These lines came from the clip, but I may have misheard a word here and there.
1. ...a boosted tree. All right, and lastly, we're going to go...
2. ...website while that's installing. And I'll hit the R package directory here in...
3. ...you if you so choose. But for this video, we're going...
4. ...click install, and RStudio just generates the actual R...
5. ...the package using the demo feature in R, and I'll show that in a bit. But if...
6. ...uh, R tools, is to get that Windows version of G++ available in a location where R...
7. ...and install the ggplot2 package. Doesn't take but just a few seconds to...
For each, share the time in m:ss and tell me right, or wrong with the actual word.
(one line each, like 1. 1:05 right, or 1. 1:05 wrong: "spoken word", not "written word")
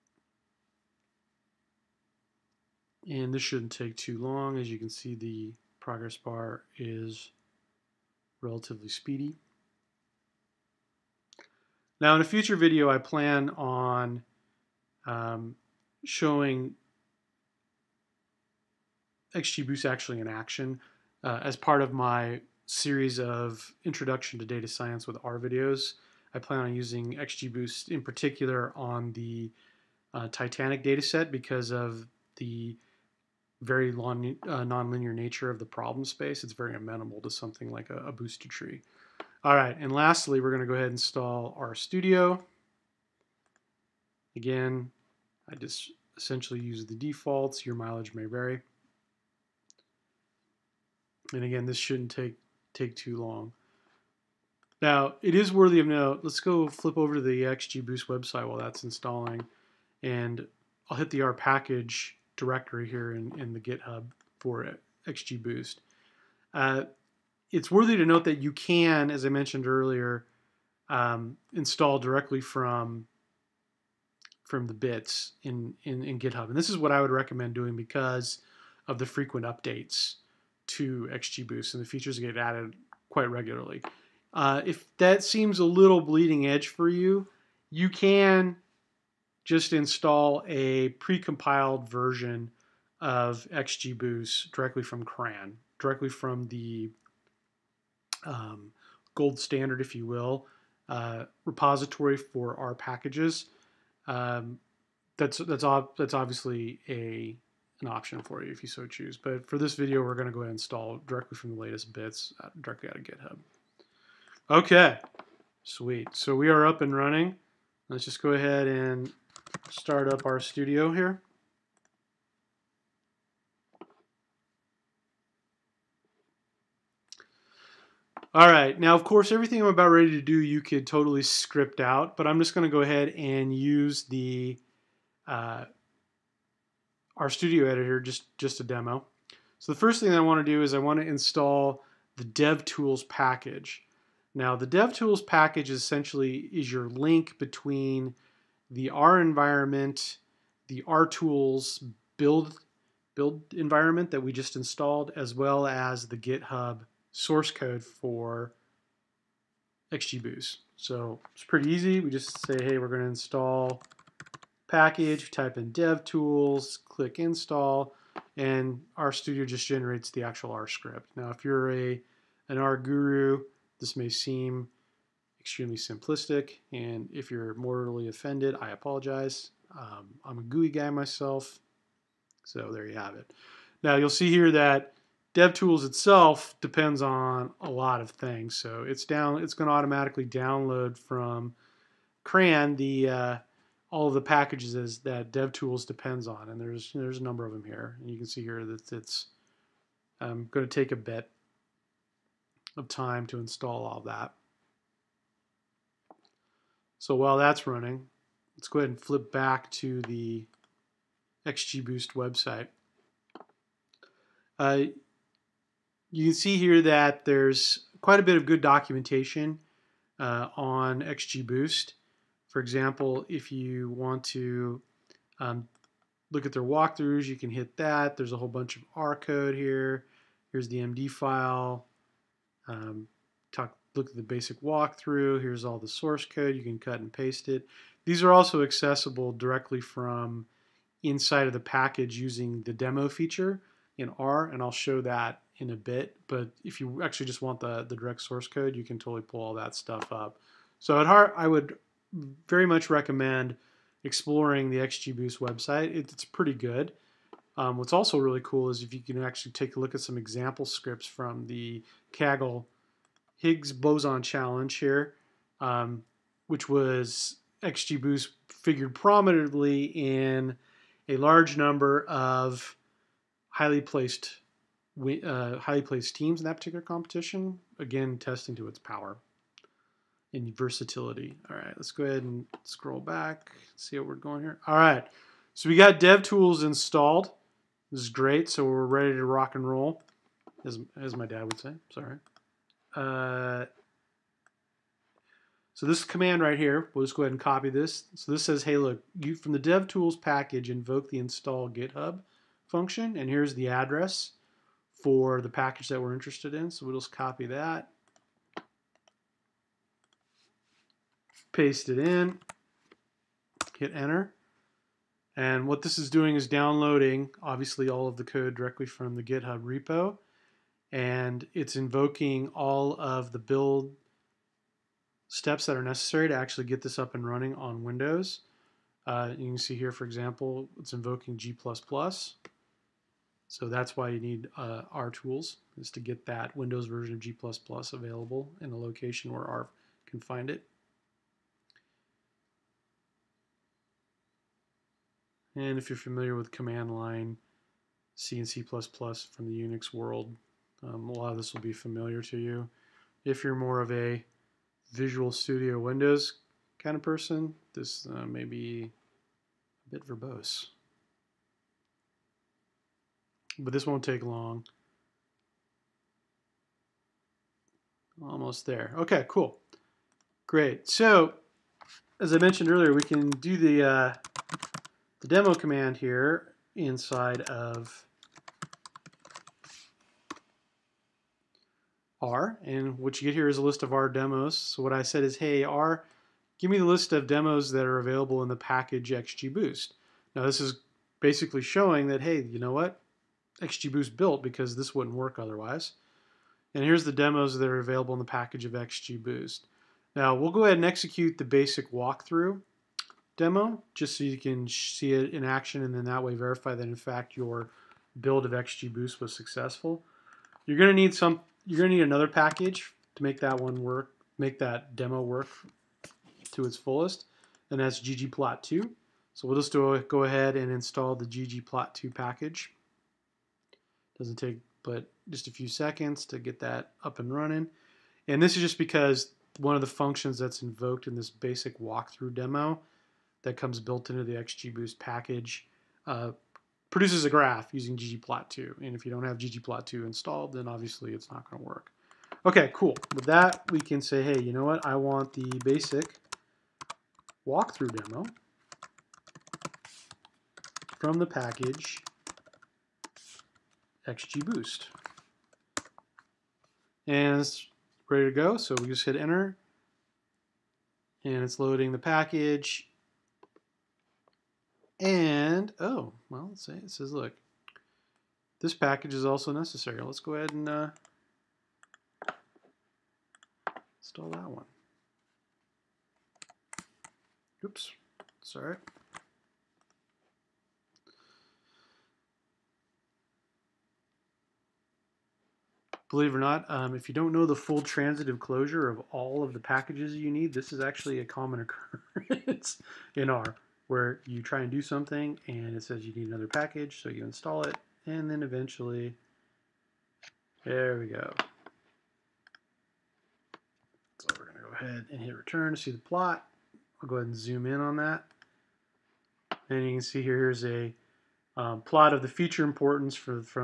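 1. 0:37 right
2. 0:58 right
3. 1:48 right
4. 2:46 right
5. 4:01 right
6. 5:34 right
7. 7:00 right.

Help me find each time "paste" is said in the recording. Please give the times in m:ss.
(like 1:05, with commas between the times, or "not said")
3:57, 5:11.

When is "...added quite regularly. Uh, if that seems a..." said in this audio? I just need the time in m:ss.
1:22.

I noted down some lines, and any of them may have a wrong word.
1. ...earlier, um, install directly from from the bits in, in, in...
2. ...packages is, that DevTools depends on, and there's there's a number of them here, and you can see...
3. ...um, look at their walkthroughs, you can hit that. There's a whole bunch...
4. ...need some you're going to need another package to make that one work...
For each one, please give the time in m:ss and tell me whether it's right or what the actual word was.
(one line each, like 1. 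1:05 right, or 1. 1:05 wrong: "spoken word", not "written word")
1. 1:09 right
2. 3:14 right
3. 3:45 right
4. 6:50 right.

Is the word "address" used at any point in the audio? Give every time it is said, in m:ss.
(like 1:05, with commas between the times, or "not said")
5:03.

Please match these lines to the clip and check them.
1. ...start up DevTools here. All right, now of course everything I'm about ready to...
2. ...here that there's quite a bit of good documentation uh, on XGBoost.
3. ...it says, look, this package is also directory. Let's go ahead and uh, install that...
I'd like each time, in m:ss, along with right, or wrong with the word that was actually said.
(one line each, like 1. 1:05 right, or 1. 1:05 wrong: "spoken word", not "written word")
1. 1:59 wrong: "RStudio", not "DevTools"
2. 3:36 right
3. 7:46 wrong: "necessary", not "directory".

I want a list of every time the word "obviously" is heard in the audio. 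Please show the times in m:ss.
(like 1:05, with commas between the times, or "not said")
1:46, 5:17, 7:20.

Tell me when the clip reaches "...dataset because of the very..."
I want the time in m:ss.
0:30.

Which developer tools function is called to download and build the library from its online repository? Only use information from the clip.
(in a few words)
install GitHub.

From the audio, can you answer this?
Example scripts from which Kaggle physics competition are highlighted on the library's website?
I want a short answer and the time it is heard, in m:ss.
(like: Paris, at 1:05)
Higgs boson challenge, at 4:23.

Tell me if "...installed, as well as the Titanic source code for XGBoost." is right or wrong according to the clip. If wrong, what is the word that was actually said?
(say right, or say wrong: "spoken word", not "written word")
wrong: "GitHub", not "Titanic".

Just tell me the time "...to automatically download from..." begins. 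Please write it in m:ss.
3:09.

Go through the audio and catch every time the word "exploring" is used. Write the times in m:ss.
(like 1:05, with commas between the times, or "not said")
4:14.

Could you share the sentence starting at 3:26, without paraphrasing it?
So while that's running, let's go ahead and flip back to the XGBoost website.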